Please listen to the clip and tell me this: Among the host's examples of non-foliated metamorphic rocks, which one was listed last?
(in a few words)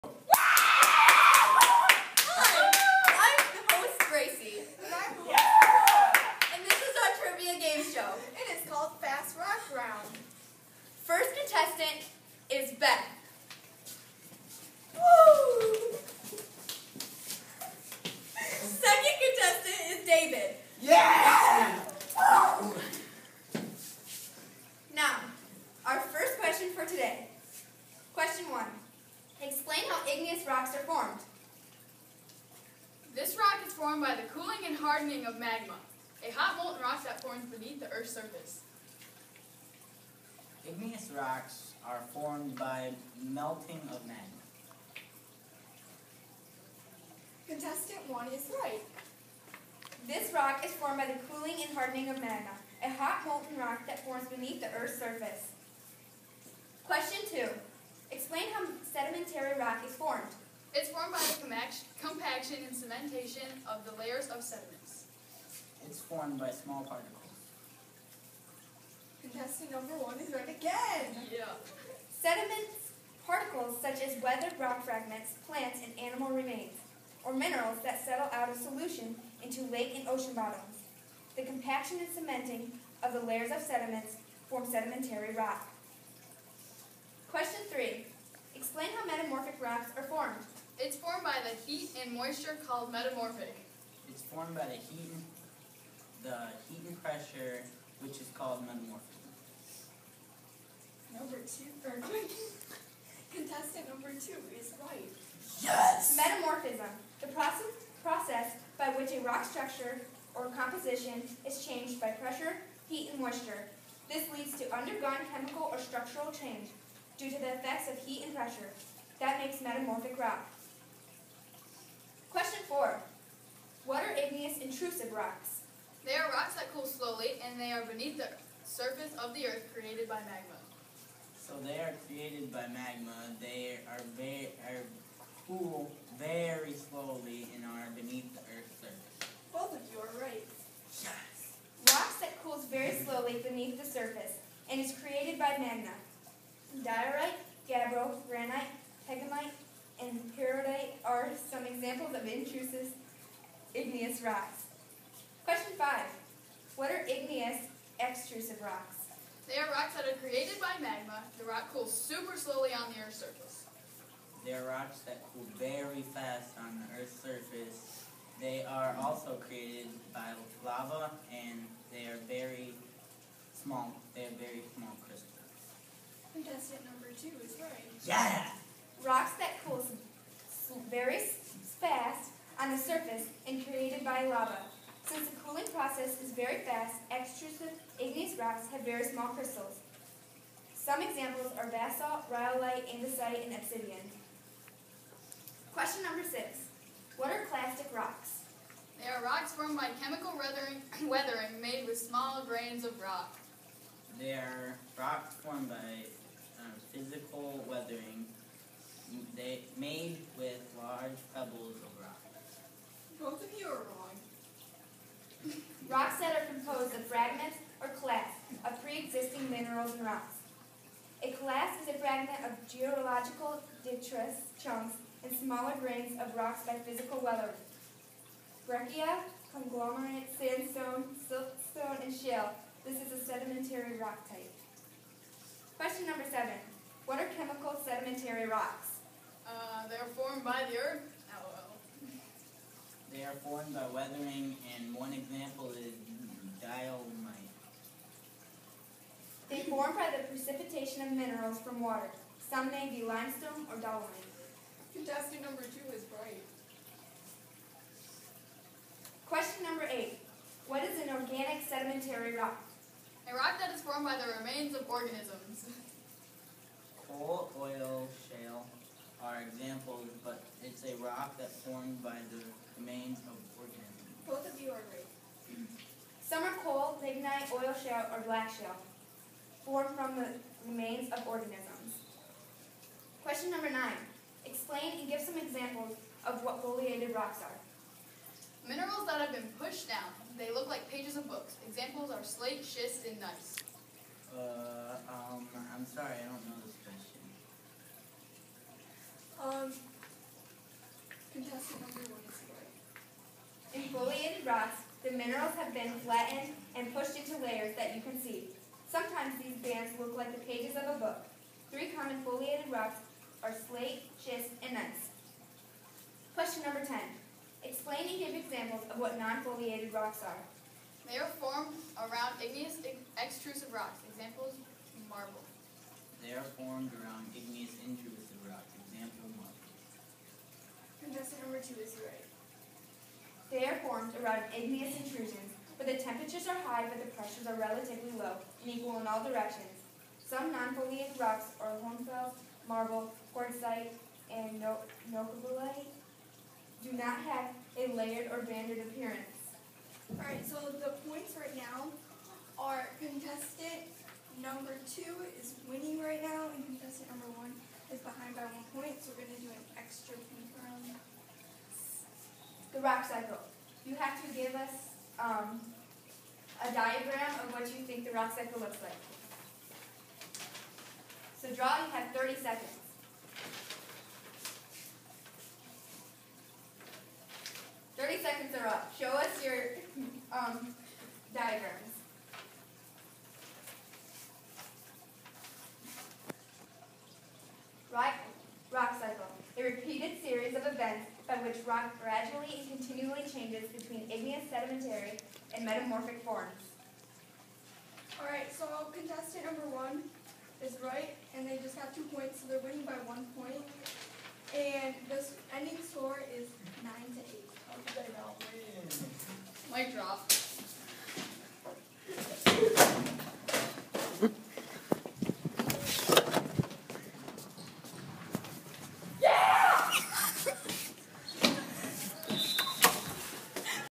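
novaculite.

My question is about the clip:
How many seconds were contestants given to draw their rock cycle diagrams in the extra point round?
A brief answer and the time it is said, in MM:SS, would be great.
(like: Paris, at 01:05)
30, at 06:12.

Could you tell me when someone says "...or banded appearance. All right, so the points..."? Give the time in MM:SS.
05:48.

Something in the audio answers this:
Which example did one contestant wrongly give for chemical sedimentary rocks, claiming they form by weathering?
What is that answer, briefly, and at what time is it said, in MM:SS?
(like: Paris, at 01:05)
diolite, at 04:06.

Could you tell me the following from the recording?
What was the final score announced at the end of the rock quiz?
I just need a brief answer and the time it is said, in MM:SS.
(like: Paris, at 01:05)
9 to 8, at 06:46.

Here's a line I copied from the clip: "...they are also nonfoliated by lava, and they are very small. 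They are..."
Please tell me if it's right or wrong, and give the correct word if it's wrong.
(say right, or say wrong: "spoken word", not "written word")
wrong: "created", not "nonfoliated".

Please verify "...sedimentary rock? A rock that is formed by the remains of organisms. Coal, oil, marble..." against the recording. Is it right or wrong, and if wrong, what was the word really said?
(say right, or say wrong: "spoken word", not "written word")
wrong: "shale", not "marble".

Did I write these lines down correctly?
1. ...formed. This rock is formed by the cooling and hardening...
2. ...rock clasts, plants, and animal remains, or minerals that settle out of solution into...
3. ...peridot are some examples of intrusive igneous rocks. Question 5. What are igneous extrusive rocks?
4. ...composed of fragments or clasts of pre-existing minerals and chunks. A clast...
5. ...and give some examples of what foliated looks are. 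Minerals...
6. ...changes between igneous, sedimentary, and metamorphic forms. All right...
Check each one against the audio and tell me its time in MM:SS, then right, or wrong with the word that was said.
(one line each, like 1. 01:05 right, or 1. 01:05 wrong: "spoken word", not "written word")
1. 00:30 right
2. 01:14 wrong: "fragments", not "clasts"
3. 02:30 right
4. 03:36 wrong: "rocks", not "chunks"
5. 04:44 wrong: "rocks", not "looks"
6. 06:33 right.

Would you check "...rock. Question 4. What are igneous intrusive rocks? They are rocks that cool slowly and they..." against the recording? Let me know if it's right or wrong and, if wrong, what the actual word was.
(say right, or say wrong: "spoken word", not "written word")
right.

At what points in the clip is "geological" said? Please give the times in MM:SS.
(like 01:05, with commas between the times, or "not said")
03:42.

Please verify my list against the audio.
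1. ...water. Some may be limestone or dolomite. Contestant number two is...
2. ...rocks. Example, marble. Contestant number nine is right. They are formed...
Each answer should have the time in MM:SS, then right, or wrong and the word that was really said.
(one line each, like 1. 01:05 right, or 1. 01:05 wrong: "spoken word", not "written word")
1. 04:11 right
2. 05:28 wrong: "two", not "nine".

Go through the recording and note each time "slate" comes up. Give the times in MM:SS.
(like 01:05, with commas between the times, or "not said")
04:52, 05:13.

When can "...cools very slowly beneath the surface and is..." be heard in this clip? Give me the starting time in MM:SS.
02:22.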